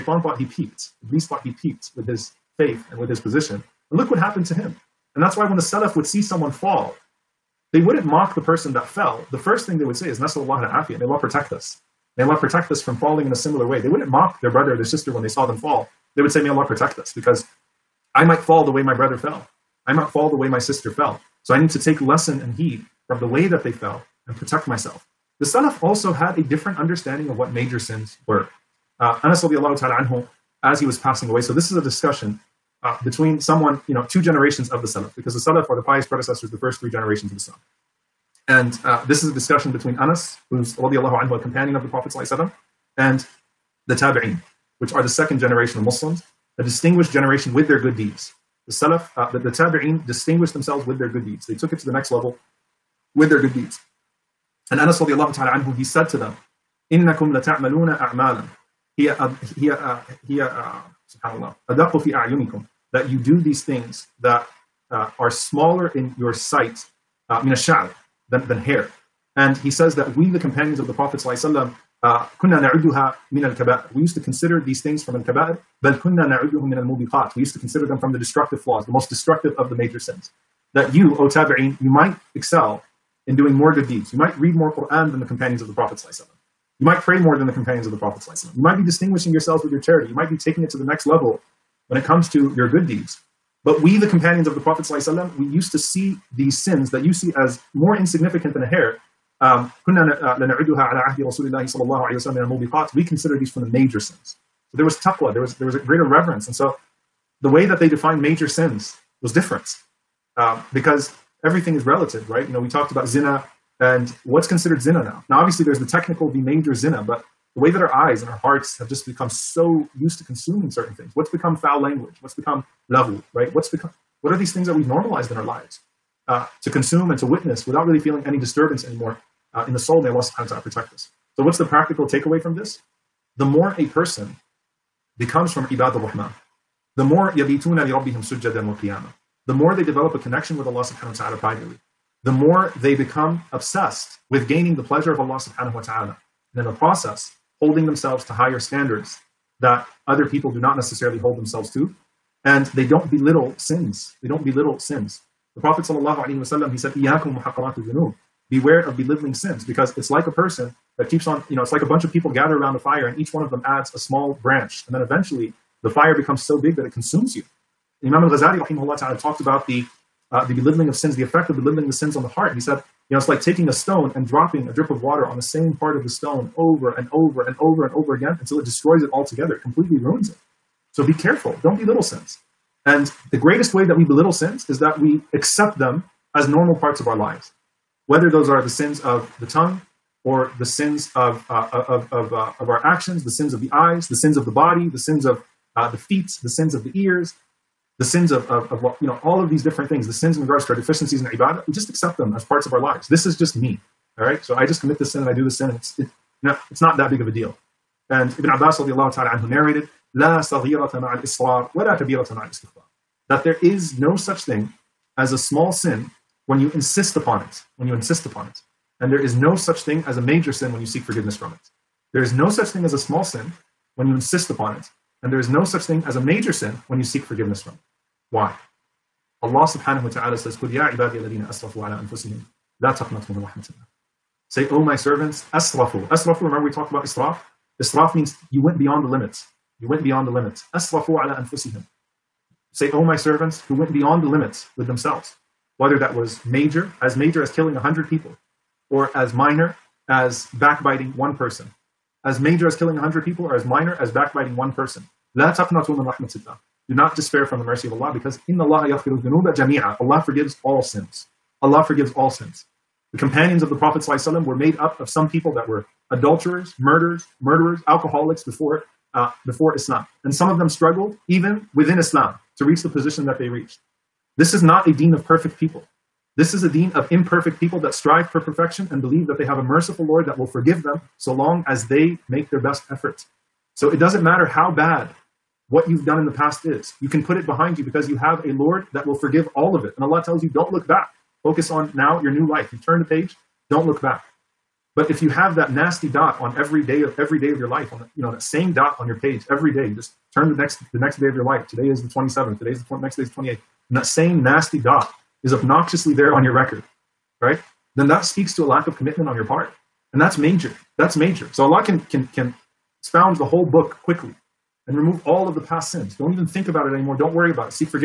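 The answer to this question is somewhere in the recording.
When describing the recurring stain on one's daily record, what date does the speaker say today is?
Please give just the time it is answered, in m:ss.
5:01.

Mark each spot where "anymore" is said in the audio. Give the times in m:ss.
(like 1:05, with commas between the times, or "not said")
2:08, 5:16.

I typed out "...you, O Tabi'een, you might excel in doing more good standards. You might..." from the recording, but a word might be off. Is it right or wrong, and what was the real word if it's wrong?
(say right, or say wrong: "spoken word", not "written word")
wrong: "deeds", not "standards".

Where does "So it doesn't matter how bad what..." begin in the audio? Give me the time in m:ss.
4:43.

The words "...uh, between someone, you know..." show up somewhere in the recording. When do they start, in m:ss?
0:32.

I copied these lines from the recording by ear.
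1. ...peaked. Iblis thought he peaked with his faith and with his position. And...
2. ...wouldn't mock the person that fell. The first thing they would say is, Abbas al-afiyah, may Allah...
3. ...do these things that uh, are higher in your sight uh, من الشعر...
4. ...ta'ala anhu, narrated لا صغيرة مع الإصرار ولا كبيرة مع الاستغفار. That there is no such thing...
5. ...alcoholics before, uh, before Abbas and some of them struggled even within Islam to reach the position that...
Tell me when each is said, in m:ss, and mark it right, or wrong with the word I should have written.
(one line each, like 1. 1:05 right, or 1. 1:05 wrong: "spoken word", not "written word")
1. 0:00 right
2. 0:07 wrong: "Nasallahu", not "Abbas"
3. 1:03 wrong: "smaller", not "higher"
4. 3:29 right
5. 4:27 wrong: "Islam", not "Abbas".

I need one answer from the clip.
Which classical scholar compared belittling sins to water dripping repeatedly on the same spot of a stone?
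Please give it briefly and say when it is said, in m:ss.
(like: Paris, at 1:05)
Imam al-Ghazali, at 2:48.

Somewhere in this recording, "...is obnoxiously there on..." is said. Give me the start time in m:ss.
5:05.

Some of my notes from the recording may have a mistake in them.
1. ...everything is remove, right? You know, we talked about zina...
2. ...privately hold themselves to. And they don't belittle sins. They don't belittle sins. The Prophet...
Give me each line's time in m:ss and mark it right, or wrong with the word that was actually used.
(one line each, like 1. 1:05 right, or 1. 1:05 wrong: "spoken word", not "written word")
1. 1:51 wrong: "relative", not "remove"
2. 2:30 wrong: "necessarily", not "privately".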